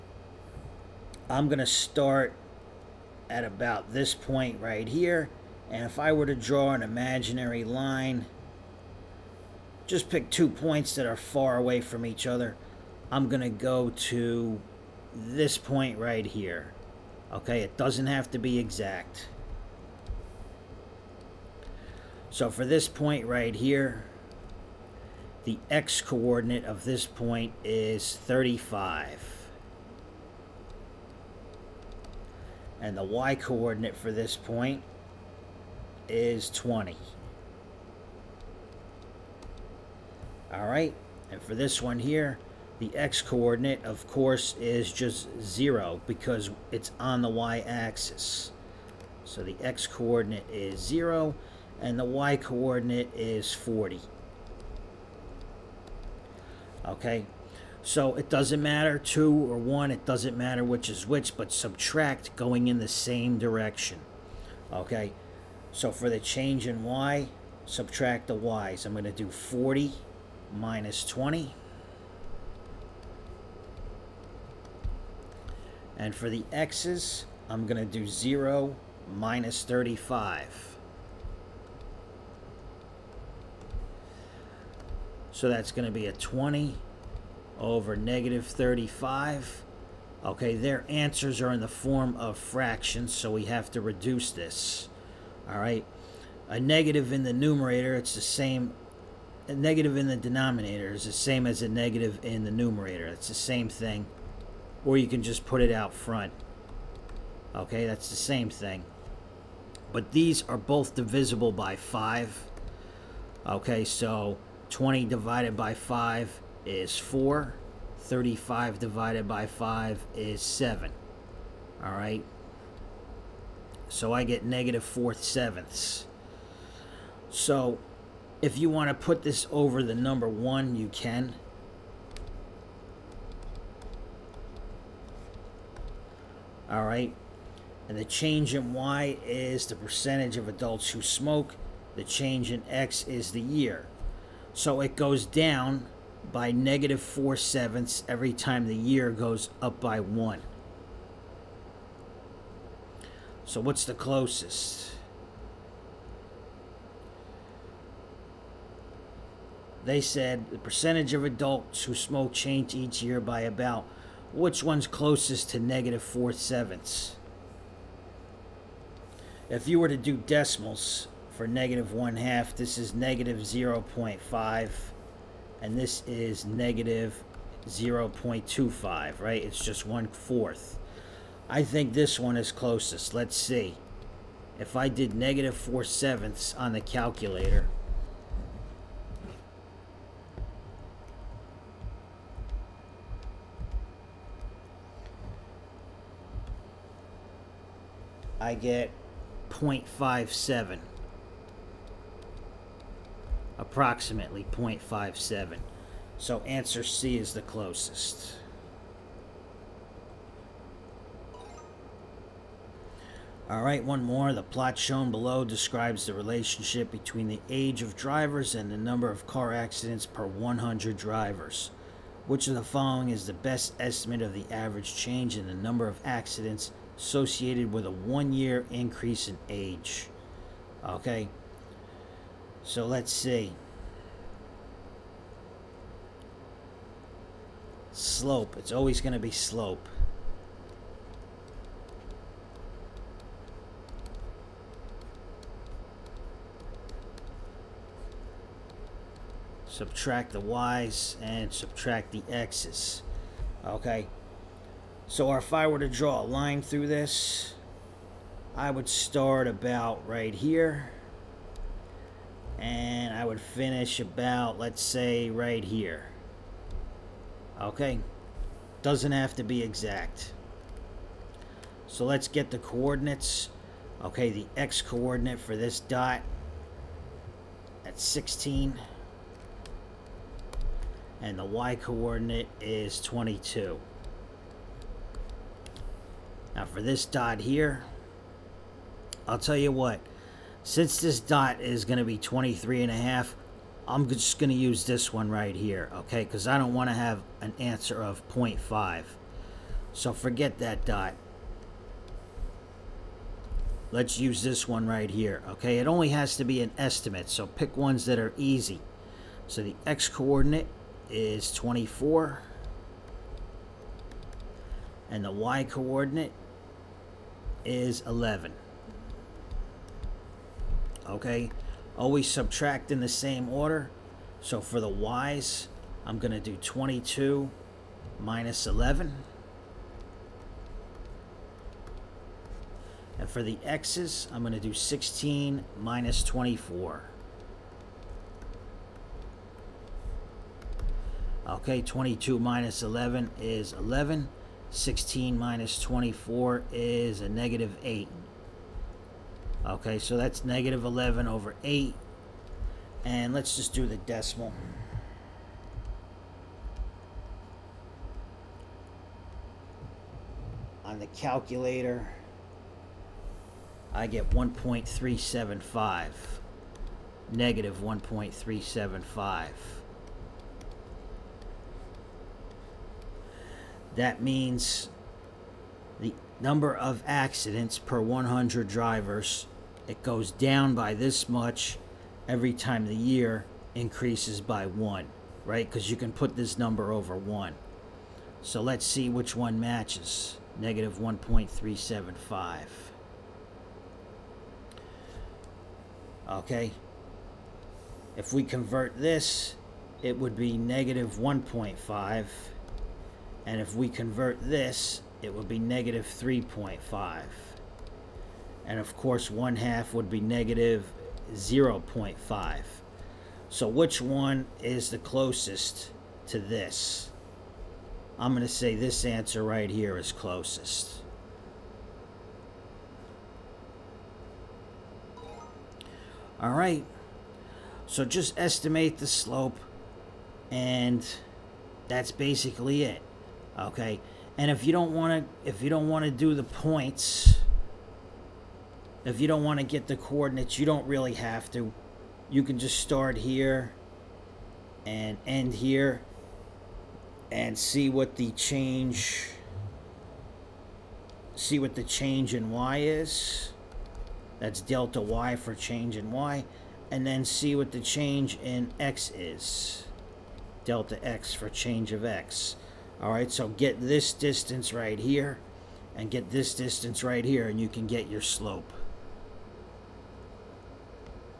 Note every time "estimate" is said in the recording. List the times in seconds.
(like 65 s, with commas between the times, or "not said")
223 s, 306 s, 428 s.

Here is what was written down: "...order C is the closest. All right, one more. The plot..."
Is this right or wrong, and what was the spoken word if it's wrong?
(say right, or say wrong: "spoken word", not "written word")
wrong: "answer", not "order".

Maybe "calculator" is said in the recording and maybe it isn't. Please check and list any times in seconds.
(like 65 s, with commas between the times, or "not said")
186 s, 361 s.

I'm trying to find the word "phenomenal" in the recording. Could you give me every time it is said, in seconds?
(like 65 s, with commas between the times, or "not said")
not said.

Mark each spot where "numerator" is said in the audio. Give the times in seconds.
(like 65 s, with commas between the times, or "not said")
97 s, 102 s.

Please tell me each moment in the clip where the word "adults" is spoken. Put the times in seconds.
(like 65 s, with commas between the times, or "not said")
140 s, 161 s.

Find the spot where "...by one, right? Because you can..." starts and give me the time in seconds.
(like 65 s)
384 s.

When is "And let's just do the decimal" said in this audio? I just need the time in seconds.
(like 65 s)
353 s.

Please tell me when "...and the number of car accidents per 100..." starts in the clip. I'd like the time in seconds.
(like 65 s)
218 s.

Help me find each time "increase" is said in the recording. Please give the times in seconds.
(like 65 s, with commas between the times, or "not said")
228 s, 383 s.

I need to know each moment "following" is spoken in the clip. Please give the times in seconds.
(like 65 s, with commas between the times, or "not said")
222 s.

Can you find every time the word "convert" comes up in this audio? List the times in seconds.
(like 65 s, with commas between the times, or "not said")
398 s, 403 s.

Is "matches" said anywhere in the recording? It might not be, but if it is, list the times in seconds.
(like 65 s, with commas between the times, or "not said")
389 s.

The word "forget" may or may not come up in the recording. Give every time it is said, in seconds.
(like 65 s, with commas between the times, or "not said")
300 s.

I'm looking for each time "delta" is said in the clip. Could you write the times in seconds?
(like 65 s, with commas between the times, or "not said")
454 s, 460 s.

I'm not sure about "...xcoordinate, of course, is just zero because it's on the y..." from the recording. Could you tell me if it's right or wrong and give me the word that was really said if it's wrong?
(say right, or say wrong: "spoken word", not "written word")
wrong: "coordinate", not "xcoordinate".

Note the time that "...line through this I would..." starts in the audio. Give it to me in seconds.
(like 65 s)
256 s.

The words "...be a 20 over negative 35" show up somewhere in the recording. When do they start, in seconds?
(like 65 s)
85 s.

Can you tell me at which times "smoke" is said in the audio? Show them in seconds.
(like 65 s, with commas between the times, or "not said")
141 s, 161 s.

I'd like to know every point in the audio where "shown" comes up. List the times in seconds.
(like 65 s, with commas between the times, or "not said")
214 s.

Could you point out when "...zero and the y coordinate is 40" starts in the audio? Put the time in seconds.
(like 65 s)
50 s.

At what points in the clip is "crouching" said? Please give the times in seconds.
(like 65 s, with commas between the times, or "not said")
not said.